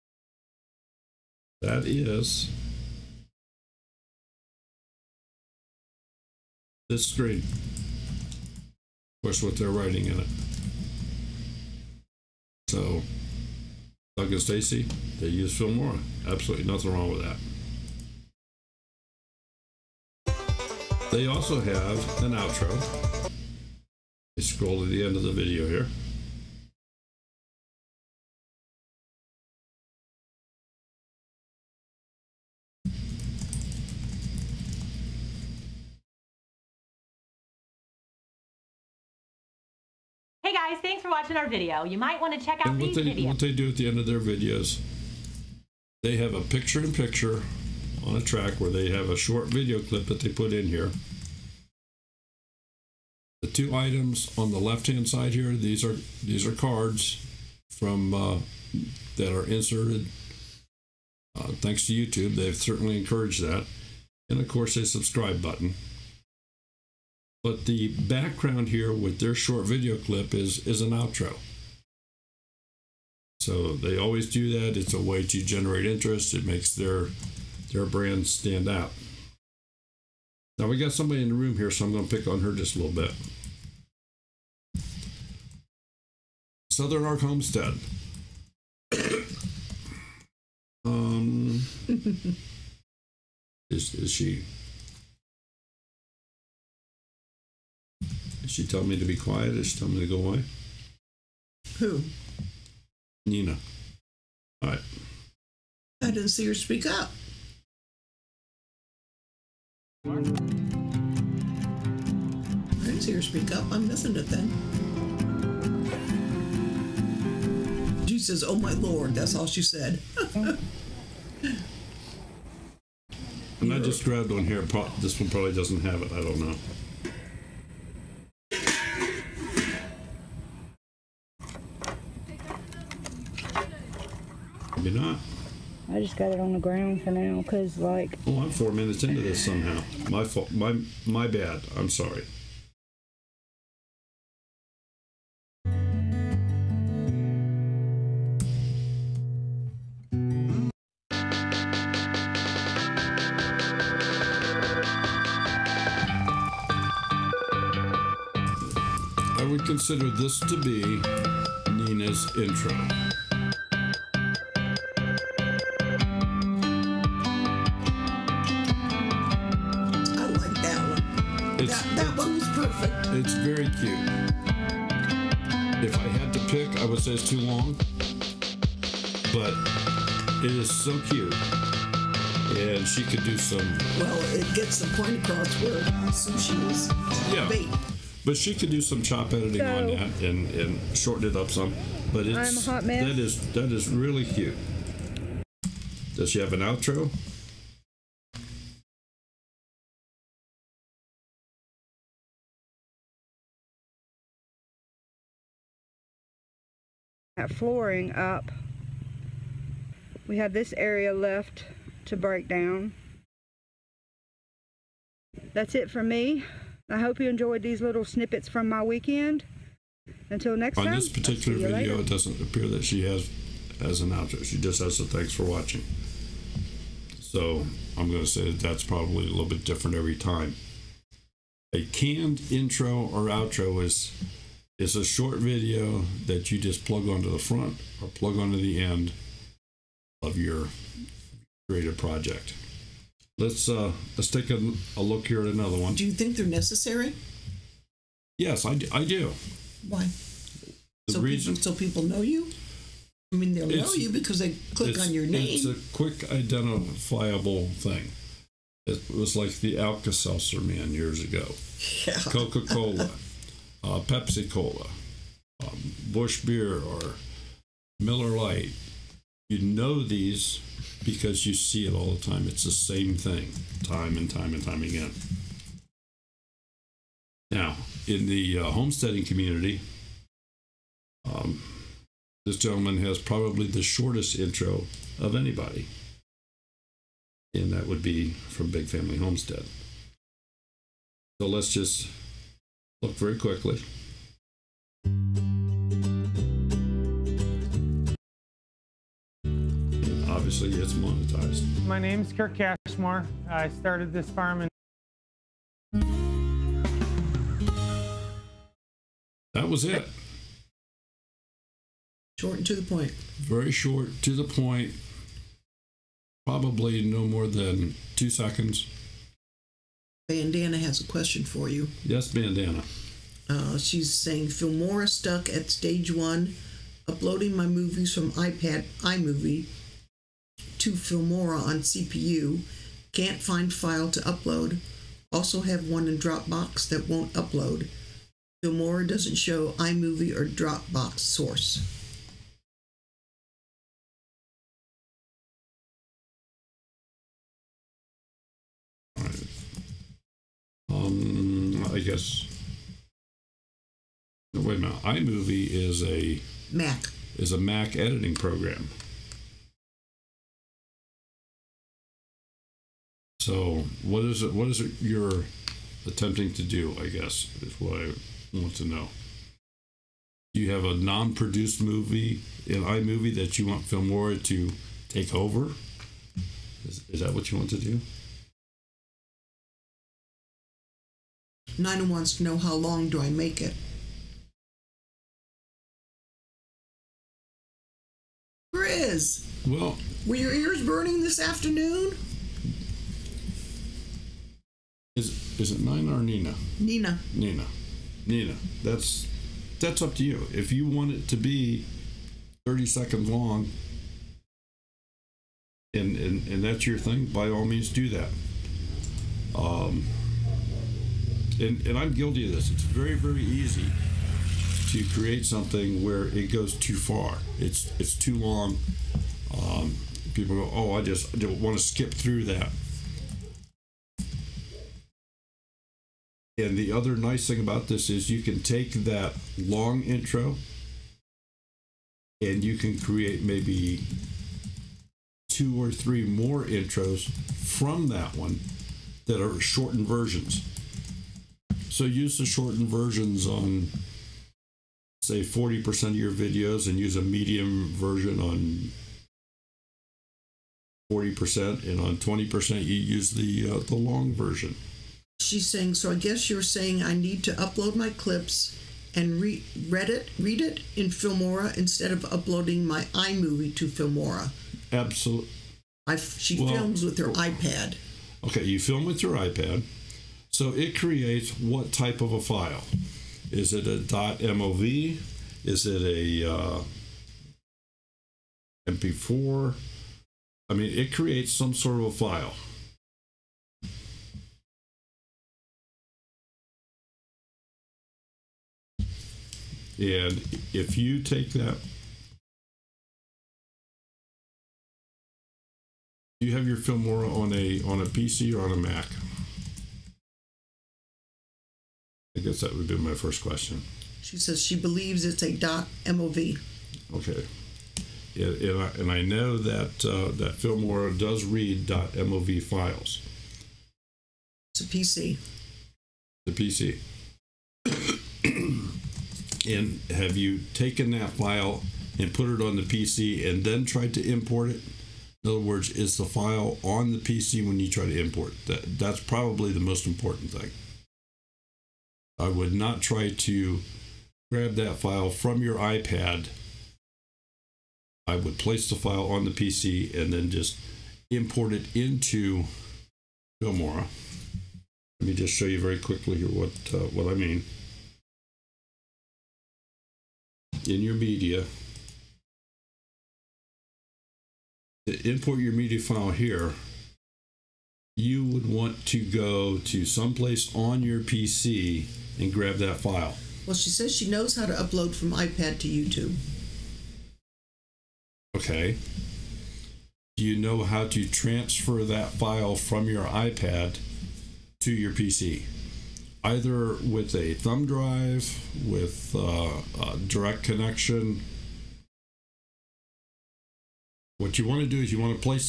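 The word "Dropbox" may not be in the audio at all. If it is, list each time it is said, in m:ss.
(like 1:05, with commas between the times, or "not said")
5:36, 5:40.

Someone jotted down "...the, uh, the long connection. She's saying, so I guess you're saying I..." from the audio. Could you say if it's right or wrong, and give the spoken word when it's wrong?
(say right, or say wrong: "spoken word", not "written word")
wrong: "version", not "connection".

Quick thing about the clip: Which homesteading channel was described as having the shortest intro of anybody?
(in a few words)
Big Family Homestead.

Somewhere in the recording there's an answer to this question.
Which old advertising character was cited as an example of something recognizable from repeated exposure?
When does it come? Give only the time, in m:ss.
4:19.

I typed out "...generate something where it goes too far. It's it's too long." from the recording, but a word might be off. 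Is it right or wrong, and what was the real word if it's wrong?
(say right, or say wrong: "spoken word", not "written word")
wrong: "create", not "generate".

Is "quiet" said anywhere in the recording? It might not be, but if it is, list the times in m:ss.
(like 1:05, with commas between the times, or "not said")
1:39.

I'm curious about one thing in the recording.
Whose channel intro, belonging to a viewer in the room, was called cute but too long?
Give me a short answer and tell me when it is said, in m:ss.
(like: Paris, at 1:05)
Southern Ark Homestead, at 1:26.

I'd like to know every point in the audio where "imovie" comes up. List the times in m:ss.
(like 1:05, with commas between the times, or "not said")
5:29, 5:39, 5:55, 6:12, 7:43.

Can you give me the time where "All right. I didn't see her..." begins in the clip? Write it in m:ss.
1:44.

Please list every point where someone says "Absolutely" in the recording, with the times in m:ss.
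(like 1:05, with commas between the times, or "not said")
0:16, 7:44.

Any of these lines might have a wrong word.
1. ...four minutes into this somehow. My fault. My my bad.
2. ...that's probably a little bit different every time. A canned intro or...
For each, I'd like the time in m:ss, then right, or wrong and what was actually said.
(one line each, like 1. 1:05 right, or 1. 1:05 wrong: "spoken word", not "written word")
1. 2:18 right
2. 3:48 right.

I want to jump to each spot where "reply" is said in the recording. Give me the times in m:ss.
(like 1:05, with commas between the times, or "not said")
not said.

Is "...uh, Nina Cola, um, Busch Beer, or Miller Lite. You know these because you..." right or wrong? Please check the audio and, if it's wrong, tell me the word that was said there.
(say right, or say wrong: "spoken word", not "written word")
wrong: "Pepsi", not "Nina".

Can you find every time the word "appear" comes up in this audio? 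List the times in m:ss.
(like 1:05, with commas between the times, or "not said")
3:42.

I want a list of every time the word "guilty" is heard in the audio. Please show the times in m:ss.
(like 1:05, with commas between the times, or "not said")
6:52.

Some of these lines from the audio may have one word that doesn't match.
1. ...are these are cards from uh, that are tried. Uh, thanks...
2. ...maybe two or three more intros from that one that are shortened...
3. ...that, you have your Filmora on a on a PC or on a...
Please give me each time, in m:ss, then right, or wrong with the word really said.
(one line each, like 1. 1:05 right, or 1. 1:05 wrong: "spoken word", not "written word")
1. 0:55 wrong: "inserted", not "tried"
2. 7:13 right
3. 8:11 right.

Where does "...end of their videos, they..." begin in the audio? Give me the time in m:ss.
0:43.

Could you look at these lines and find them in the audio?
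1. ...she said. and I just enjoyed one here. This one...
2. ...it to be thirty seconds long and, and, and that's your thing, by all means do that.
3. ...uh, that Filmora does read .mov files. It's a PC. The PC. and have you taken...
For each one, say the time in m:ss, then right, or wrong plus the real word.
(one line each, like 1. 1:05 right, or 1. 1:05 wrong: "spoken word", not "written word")
1. 1:59 wrong: "grabbed", not "enjoyed"
2. 6:41 right
3. 8:30 right.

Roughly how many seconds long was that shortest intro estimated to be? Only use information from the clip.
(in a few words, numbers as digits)
2.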